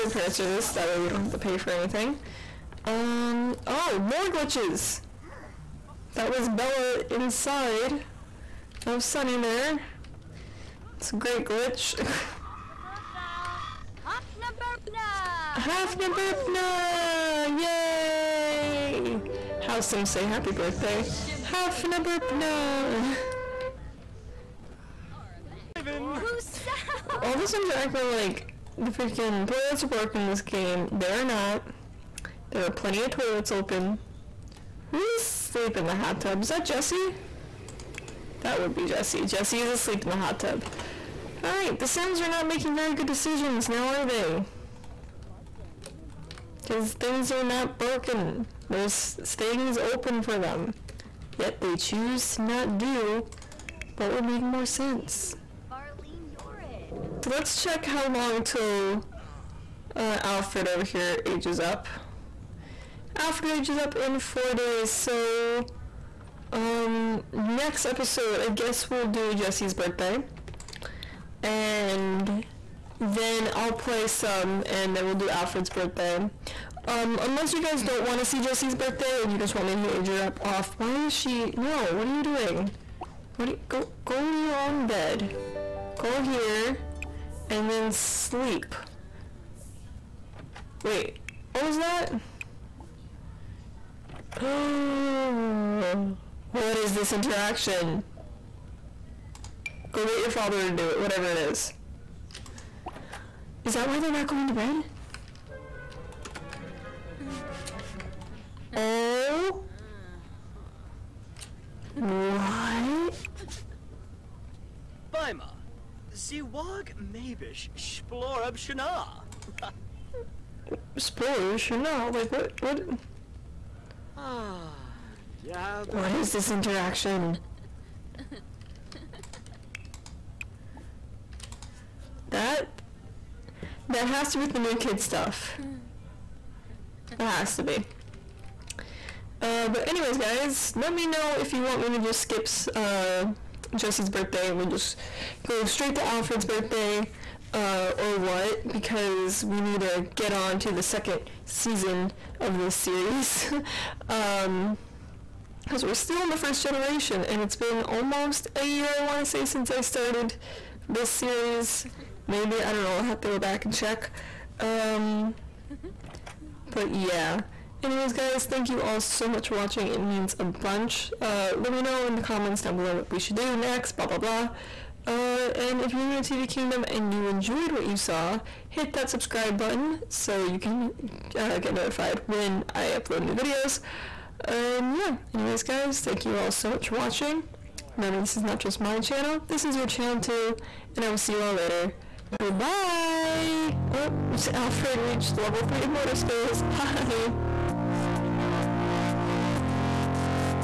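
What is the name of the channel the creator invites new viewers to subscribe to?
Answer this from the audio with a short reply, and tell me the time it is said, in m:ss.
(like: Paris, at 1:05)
TV Kingdom, at 2:56.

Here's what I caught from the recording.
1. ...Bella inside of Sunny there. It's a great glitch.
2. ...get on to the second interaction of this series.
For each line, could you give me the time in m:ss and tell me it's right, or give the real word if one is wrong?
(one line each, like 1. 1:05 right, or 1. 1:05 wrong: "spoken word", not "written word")
1. 0:06 right
2. 2:30 wrong: "season", not "interaction".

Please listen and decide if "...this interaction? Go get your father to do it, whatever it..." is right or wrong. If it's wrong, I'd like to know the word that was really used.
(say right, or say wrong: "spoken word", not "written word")
right.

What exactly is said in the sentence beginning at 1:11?
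And then I'll play some, and then we'll do Alfred's birthday.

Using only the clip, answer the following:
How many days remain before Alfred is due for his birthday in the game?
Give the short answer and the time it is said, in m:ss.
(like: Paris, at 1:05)
4, at 1:04.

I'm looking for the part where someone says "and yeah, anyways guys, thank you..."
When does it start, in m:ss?
3:04.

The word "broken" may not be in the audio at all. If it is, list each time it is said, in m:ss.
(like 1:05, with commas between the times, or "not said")
0:29, 0:47.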